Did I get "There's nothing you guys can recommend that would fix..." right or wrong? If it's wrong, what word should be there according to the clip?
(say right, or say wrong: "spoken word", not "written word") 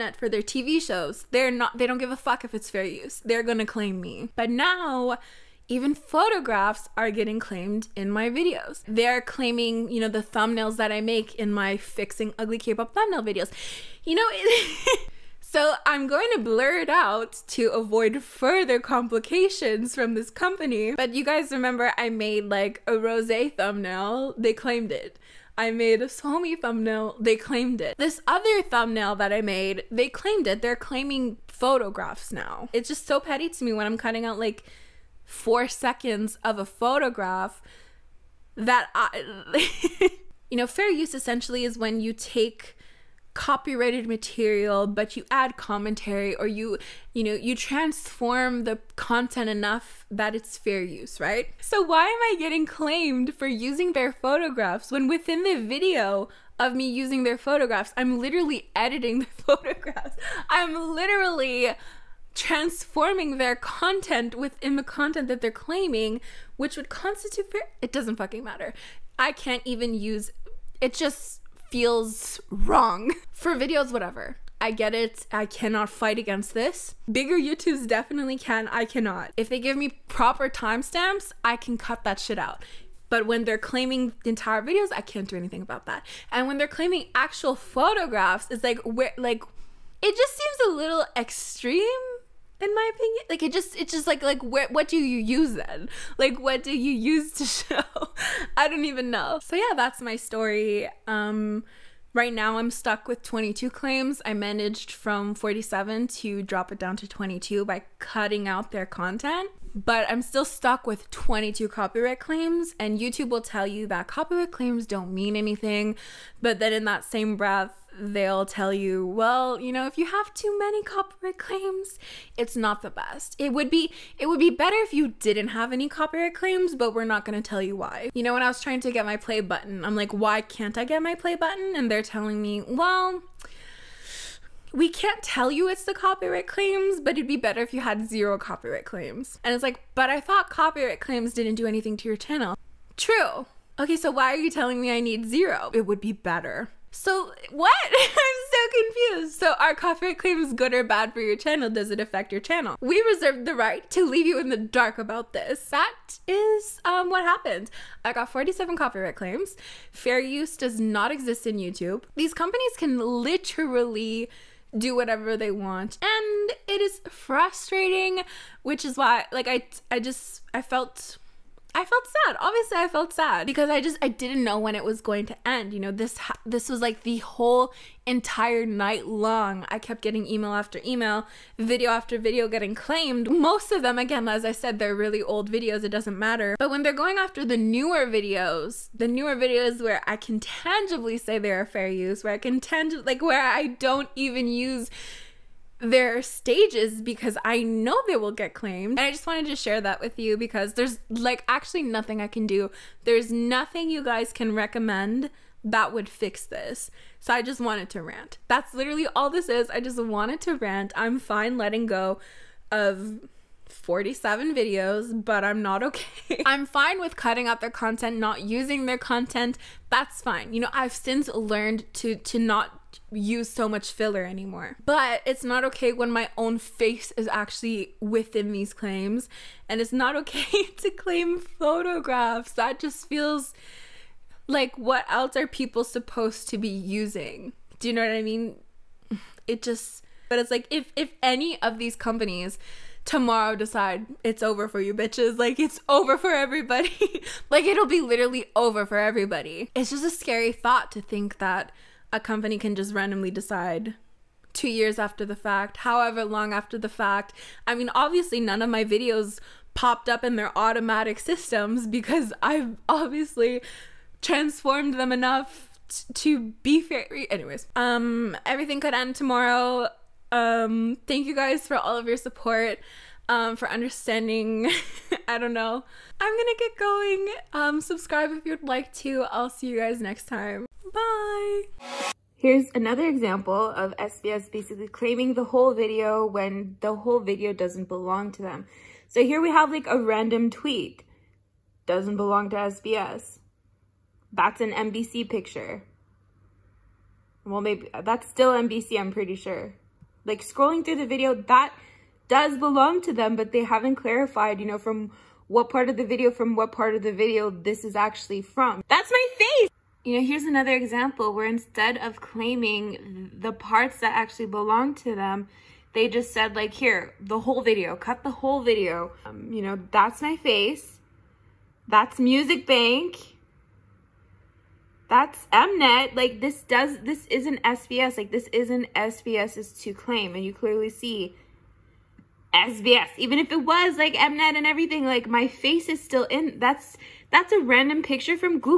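right.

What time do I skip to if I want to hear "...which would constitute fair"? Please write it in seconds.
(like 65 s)
66 s.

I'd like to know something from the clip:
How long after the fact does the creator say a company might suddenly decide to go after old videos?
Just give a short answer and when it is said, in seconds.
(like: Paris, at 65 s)
2 years, at 254 s.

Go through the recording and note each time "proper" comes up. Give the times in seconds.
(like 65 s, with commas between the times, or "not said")
80 s.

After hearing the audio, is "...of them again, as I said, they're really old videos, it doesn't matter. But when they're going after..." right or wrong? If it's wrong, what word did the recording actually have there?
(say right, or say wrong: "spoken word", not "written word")
right.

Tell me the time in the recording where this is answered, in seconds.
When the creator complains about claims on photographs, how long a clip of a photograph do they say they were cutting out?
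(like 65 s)
35 s.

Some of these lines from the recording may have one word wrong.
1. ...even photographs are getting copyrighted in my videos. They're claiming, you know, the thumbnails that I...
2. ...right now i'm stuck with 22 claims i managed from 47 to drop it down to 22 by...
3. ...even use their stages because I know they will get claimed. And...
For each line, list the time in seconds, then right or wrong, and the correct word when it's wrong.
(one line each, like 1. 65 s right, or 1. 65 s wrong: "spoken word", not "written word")
1. 5 s wrong: "claimed", not "copyrighted"
2. 102 s right
3. 194 s right.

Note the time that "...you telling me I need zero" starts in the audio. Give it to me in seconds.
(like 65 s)
144 s.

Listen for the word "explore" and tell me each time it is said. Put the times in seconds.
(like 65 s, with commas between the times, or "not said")
not said.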